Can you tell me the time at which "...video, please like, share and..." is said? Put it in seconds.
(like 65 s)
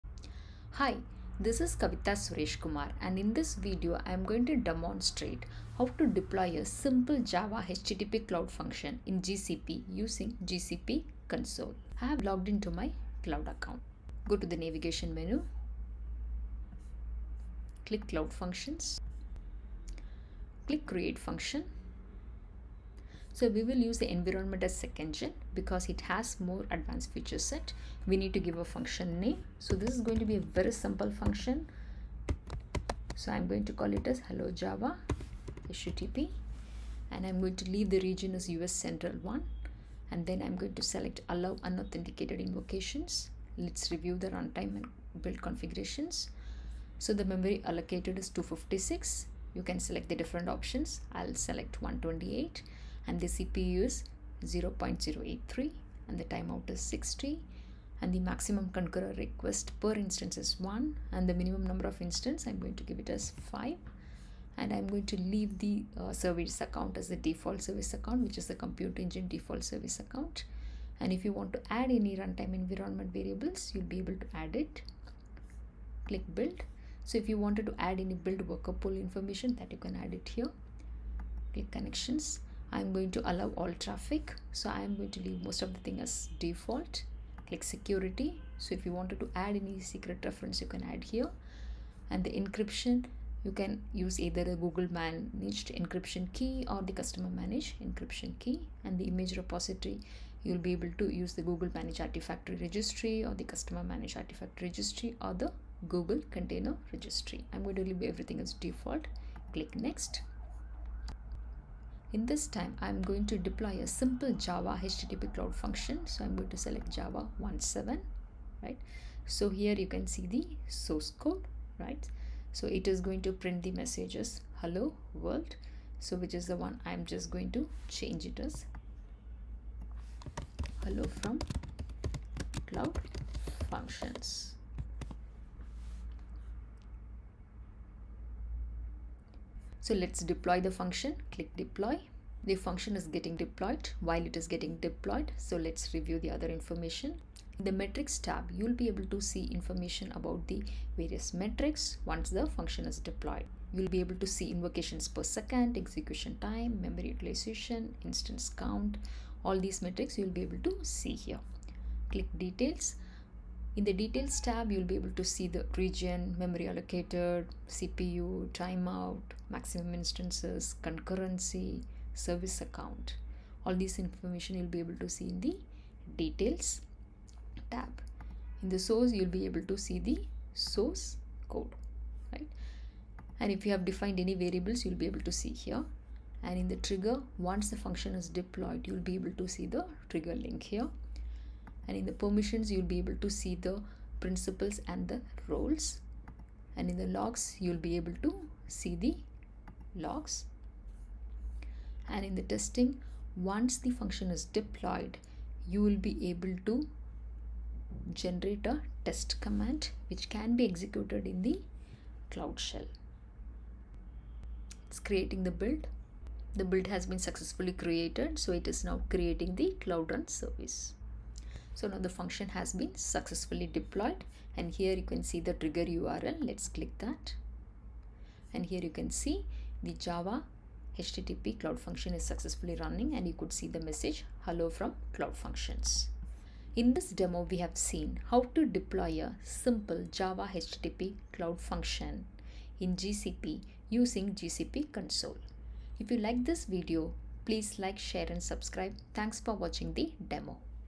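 246 s.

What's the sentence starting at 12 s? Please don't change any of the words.
I have logged into my cloud account.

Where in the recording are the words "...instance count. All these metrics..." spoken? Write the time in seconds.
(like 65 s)
158 s.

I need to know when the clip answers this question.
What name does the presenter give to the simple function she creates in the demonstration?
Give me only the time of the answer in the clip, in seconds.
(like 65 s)
34 s.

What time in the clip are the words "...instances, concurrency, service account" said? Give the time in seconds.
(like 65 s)
169 s.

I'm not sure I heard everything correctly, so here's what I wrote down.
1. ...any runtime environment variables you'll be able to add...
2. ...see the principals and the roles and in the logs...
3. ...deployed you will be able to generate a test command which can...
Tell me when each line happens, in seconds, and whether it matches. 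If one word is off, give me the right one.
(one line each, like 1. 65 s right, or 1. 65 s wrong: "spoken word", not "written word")
1. 71 s right
2. 193 s right
3. 204 s right.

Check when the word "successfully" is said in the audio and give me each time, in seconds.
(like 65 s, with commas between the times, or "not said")
217 s, 222 s, 232 s.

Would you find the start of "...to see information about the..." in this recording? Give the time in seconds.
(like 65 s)
149 s.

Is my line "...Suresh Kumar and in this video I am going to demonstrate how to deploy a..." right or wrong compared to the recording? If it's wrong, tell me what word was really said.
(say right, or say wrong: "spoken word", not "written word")
right.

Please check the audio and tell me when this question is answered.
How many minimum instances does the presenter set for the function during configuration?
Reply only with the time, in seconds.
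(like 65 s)
63 s.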